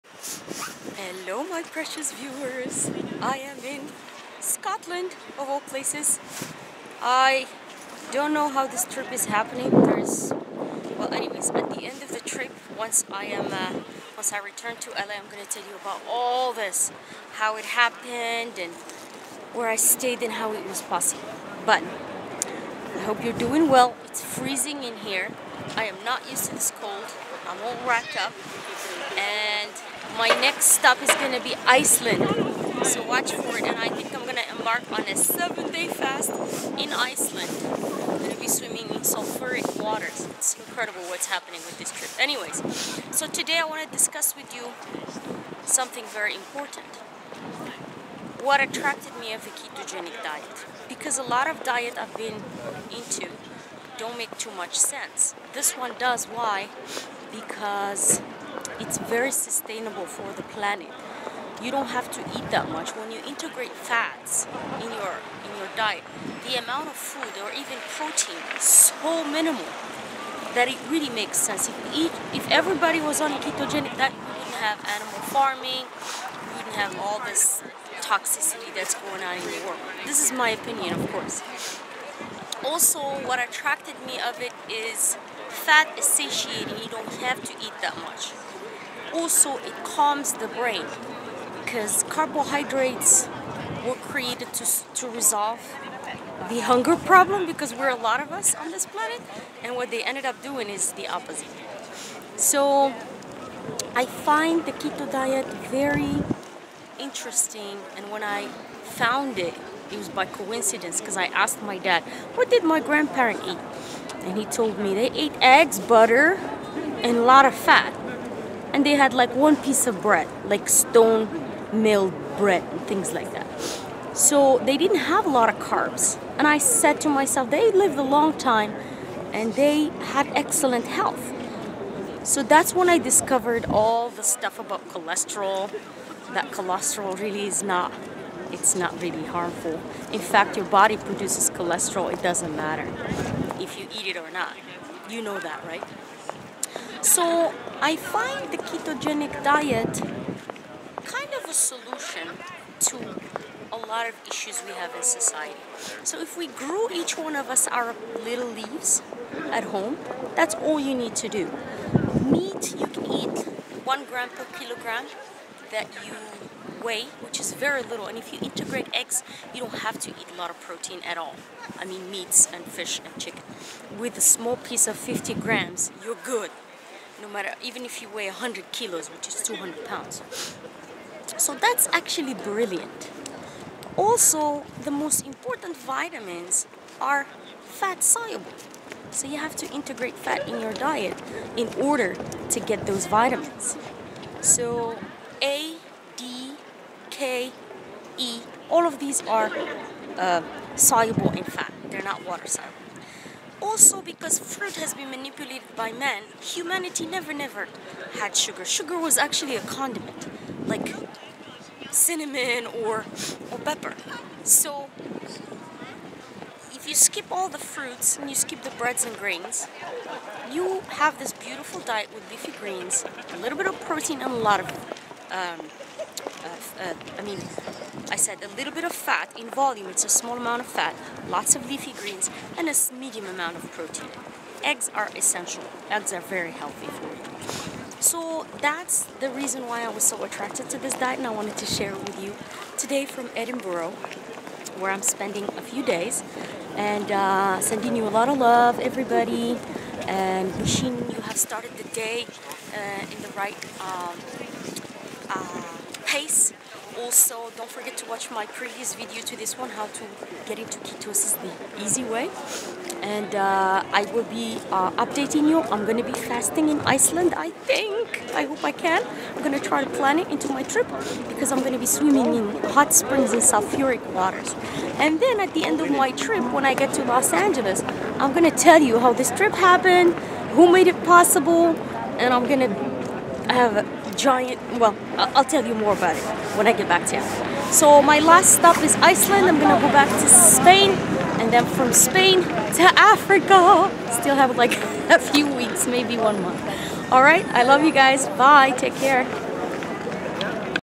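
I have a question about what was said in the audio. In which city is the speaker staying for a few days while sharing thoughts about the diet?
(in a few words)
Edinburgh.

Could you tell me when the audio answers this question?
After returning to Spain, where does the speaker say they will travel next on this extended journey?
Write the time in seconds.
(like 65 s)
292 s.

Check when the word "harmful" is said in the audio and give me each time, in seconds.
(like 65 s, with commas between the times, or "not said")
139 s.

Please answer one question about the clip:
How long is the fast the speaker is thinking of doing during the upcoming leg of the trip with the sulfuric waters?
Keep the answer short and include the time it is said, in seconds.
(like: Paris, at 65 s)
7 days, at 35 s.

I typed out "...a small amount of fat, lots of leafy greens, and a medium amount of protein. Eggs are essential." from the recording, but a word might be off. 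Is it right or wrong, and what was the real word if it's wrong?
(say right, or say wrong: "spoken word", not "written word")
right.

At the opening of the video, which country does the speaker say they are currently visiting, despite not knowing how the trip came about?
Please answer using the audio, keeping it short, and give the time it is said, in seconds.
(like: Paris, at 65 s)
Scotland, at 4 s.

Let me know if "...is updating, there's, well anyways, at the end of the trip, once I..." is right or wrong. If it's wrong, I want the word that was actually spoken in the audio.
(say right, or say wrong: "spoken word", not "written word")
wrong: "happening", not "updating".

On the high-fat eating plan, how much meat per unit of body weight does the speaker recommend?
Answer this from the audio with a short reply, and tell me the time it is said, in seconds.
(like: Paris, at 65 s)
1 gram per kilogram, at 163 s.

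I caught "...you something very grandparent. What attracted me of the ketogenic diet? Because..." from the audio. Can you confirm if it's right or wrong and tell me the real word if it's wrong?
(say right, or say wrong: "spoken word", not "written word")
wrong: "important", not "grandparent".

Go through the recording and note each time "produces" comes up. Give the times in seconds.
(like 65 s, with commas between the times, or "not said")
140 s.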